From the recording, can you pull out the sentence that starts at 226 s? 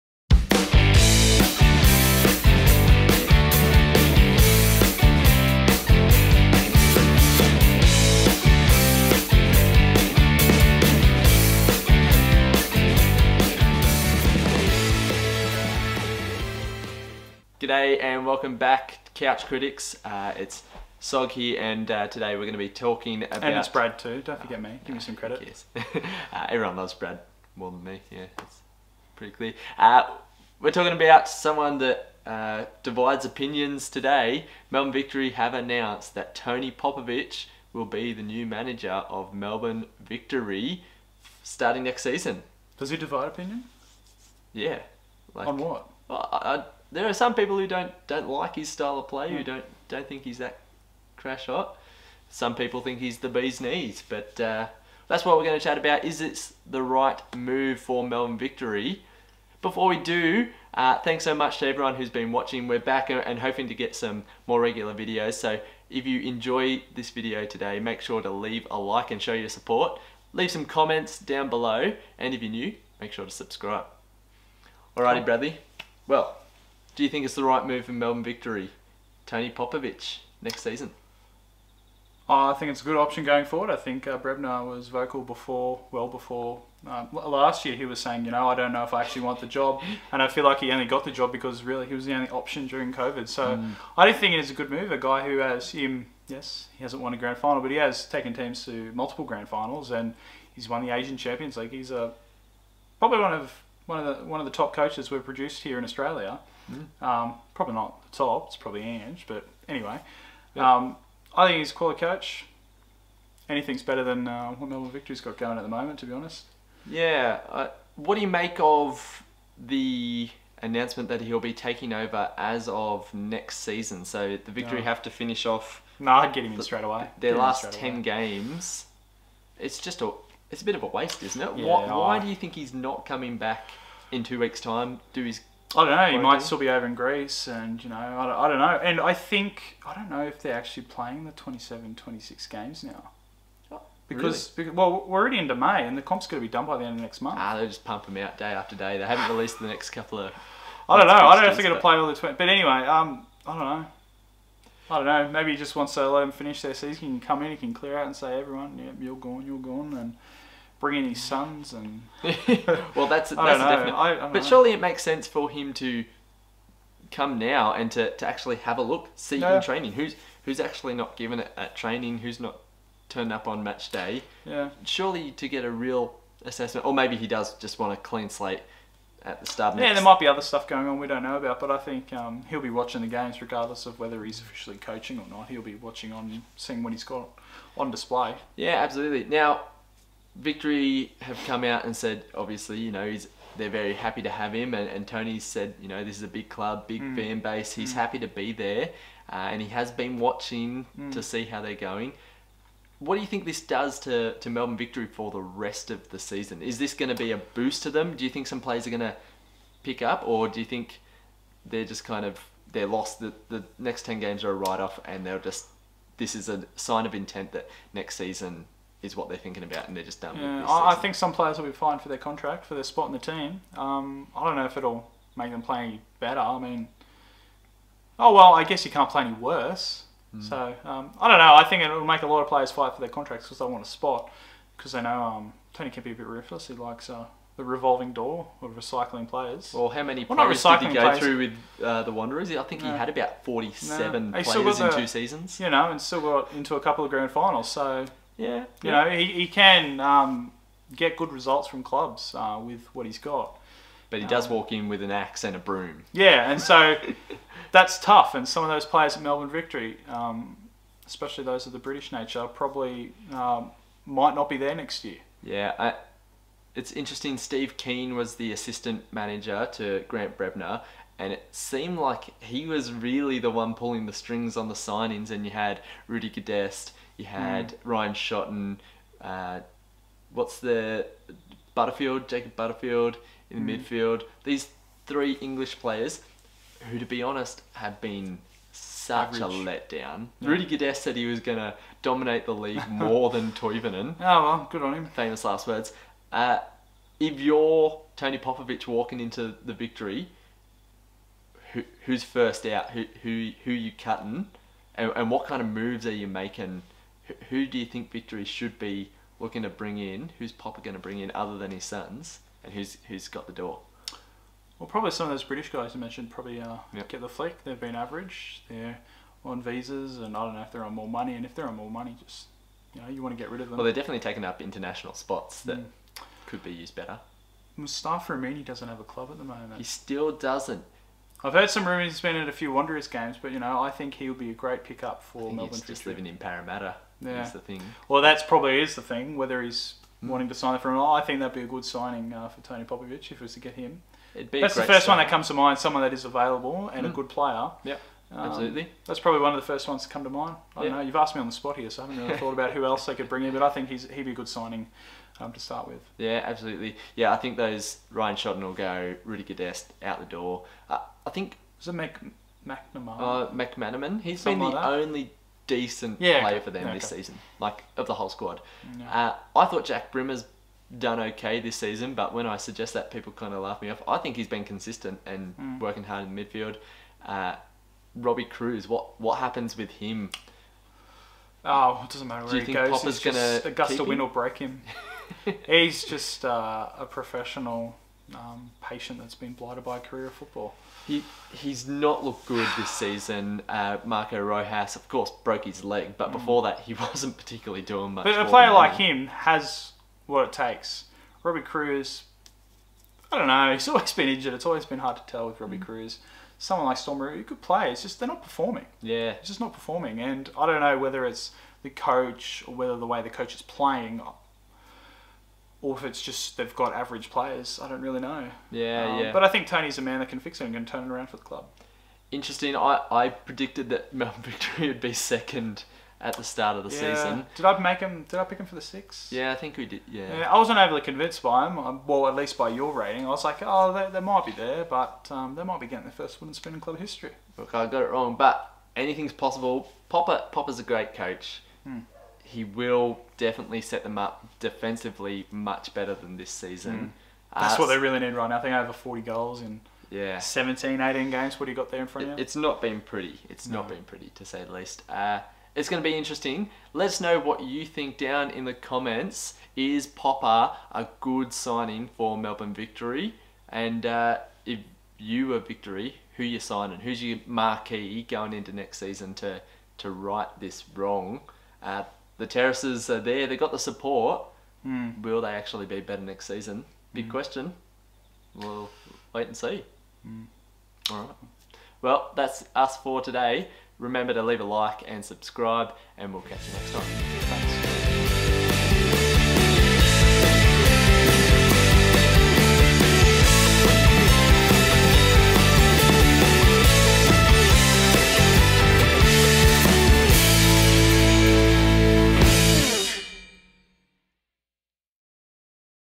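I mean, oh well, I guess you can't play any worse.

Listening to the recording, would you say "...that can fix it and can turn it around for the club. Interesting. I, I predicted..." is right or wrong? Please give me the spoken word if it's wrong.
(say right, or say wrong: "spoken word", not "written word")
right.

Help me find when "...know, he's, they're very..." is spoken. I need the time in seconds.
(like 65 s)
192 s.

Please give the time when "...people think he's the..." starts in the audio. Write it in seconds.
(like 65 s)
52 s.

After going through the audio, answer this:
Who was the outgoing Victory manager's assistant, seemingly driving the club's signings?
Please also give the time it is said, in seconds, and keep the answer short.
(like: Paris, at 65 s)
Steve Kean, at 267 s.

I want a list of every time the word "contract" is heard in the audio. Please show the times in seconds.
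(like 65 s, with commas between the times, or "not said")
222 s, 233 s.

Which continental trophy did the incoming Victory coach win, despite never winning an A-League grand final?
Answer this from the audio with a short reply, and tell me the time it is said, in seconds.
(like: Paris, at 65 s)
Asian Champions League, at 100 s.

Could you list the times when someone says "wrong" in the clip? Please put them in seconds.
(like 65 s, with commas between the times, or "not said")
438 s, 470 s.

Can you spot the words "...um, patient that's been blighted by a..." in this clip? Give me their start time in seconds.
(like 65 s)
388 s.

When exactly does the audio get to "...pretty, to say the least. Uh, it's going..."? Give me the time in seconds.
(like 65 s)
454 s.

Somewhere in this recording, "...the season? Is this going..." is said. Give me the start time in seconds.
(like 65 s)
206 s.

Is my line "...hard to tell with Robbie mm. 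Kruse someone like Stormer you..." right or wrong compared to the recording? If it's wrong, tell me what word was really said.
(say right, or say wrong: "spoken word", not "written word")
right.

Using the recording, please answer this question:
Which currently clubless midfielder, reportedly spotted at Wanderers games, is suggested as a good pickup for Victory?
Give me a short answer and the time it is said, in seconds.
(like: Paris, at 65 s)
Mustafa Amini, at 327 s.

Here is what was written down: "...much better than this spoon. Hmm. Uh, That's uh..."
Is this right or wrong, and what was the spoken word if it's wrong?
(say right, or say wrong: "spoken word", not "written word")
wrong: "season", not "spoon".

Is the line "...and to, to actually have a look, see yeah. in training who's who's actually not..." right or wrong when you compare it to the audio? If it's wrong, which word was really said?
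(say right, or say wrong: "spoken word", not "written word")
right.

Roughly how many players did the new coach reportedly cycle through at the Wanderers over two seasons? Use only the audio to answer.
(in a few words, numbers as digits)
47.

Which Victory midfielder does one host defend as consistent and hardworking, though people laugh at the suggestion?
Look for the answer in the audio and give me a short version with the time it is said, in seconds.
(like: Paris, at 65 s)
Jack Brimmer, at 369 s.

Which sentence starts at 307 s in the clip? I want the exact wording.
Who, who do you think Victory should be looking to bring in?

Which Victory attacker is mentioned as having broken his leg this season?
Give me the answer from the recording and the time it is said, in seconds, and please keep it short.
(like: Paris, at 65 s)
Marco Rojas, at 394 s.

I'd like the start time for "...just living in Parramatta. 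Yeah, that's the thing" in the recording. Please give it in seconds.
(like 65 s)
335 s.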